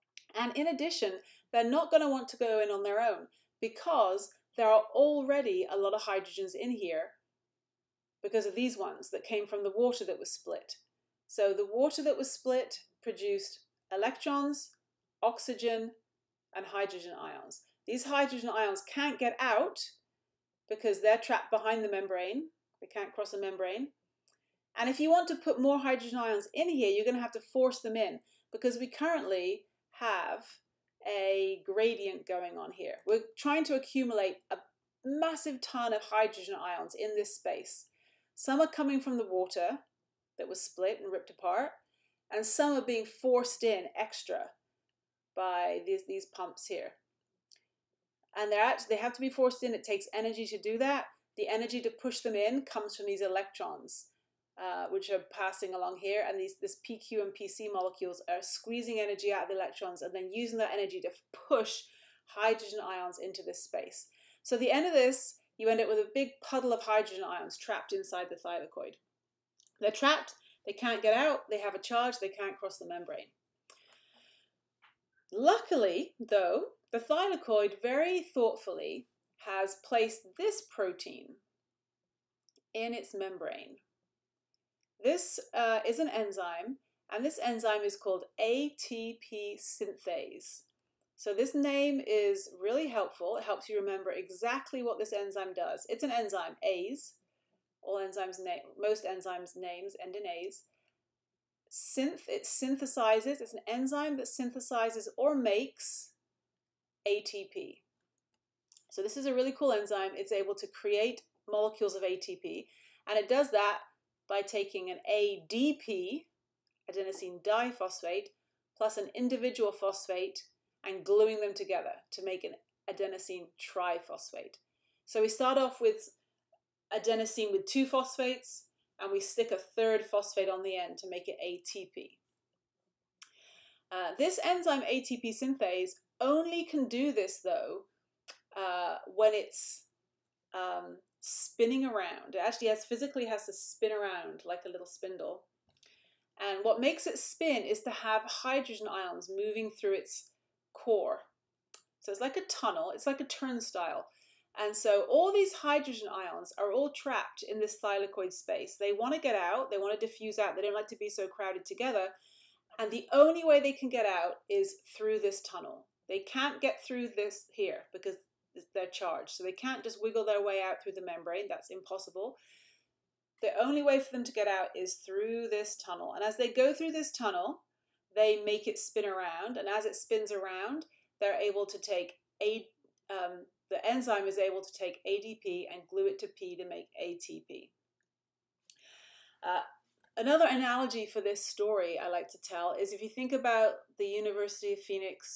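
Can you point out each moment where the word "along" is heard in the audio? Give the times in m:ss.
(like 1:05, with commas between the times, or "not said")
0:55.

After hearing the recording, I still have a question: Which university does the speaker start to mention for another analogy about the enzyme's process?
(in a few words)
University of Phoenix.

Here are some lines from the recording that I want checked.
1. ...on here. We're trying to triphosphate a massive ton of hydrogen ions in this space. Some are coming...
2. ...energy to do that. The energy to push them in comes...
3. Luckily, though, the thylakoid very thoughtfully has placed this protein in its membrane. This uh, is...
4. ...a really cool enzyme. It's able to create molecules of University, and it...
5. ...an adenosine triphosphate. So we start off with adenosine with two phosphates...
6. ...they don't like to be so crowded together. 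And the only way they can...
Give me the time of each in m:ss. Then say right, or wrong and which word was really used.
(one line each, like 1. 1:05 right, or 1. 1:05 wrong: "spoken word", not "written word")
1. 0:32 wrong: "accumulate", not "triphosphate"
2. 0:50 right
3. 1:15 right
4. 1:49 wrong: "ATP", not "University"
5. 2:02 right
6. 2:40 right.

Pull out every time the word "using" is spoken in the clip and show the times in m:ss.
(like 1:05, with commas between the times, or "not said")
1:00.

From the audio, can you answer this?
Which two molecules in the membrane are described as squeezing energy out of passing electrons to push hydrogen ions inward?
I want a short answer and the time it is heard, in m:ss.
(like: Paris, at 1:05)
PQ and PC, at 0:56.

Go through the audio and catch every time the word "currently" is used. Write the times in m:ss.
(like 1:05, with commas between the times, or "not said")
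0:28.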